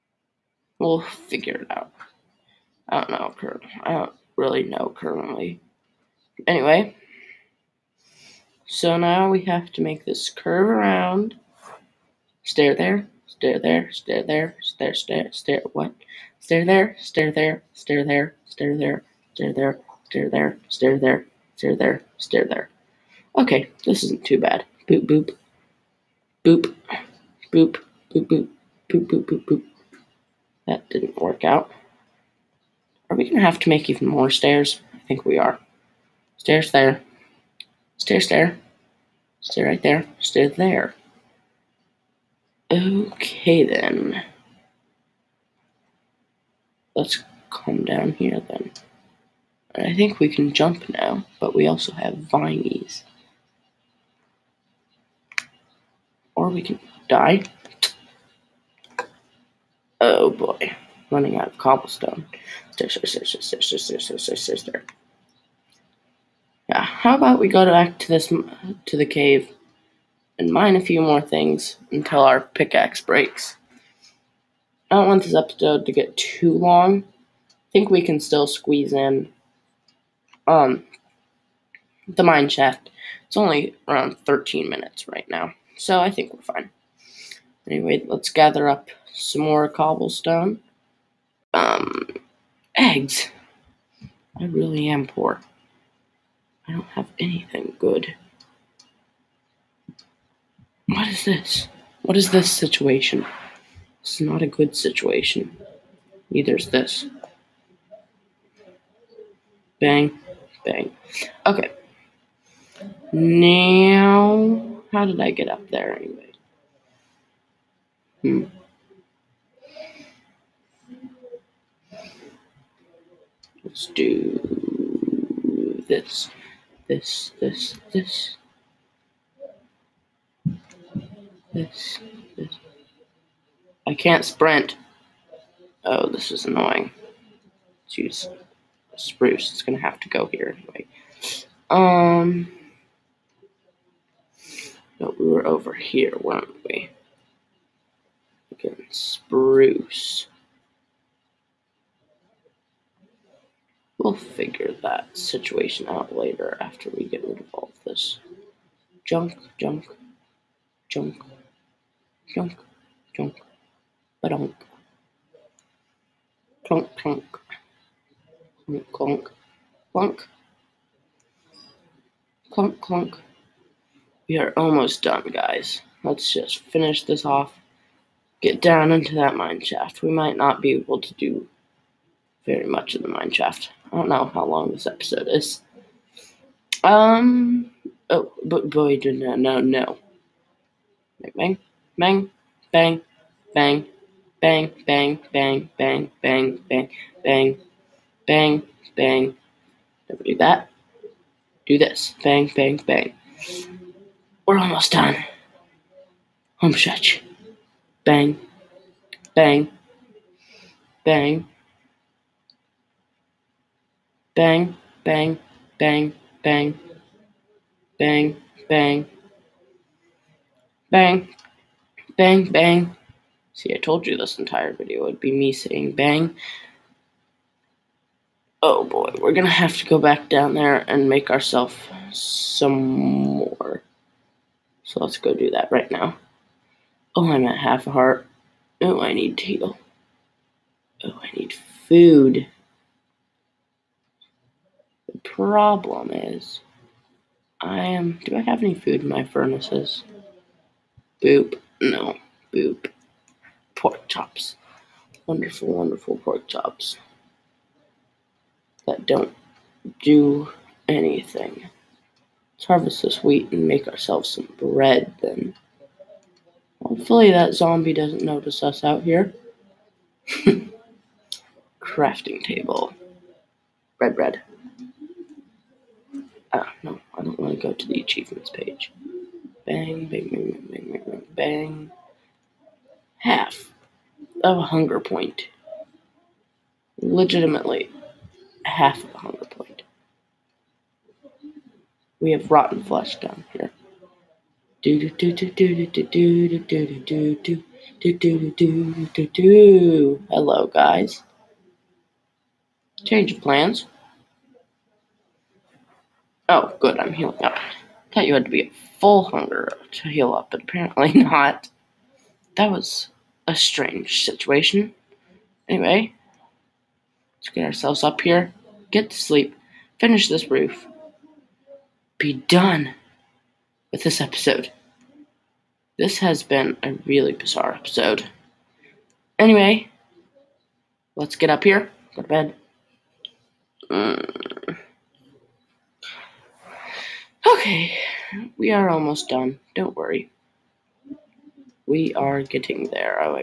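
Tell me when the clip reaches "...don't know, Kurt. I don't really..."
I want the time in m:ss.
0:02.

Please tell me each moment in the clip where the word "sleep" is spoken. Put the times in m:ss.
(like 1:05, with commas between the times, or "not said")
5:19.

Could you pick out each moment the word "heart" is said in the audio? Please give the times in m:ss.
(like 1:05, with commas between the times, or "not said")
3:57.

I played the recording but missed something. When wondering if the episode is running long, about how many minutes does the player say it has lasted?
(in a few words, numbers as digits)
13.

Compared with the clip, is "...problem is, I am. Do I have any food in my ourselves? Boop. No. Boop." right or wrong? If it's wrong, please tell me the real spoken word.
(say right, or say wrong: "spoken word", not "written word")
wrong: "furnaces", not "ourselves".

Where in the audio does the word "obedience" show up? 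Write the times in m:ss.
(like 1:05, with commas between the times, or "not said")
not said.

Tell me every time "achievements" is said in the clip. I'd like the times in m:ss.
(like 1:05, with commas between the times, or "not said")
4:37.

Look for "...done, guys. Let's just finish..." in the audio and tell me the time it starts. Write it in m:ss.
2:55.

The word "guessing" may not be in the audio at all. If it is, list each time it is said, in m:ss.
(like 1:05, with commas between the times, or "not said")
not said.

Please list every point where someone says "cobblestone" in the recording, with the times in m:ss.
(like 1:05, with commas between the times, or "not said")
1:01, 1:29.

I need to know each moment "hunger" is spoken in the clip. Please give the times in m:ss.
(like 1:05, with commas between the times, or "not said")
4:44, 4:49, 5:09.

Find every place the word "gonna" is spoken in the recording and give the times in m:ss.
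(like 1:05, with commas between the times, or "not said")
0:33, 2:19, 3:49.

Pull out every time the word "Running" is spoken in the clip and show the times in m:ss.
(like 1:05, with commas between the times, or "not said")
1:01.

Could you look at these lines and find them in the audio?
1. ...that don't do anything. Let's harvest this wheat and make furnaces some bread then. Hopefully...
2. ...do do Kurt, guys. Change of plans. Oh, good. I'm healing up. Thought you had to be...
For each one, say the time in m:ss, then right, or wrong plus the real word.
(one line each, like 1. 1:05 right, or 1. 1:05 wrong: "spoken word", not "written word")
1. 4:18 wrong: "ourselves", not "furnaces"
2. 4:59 wrong: "Hello", not "Kurt".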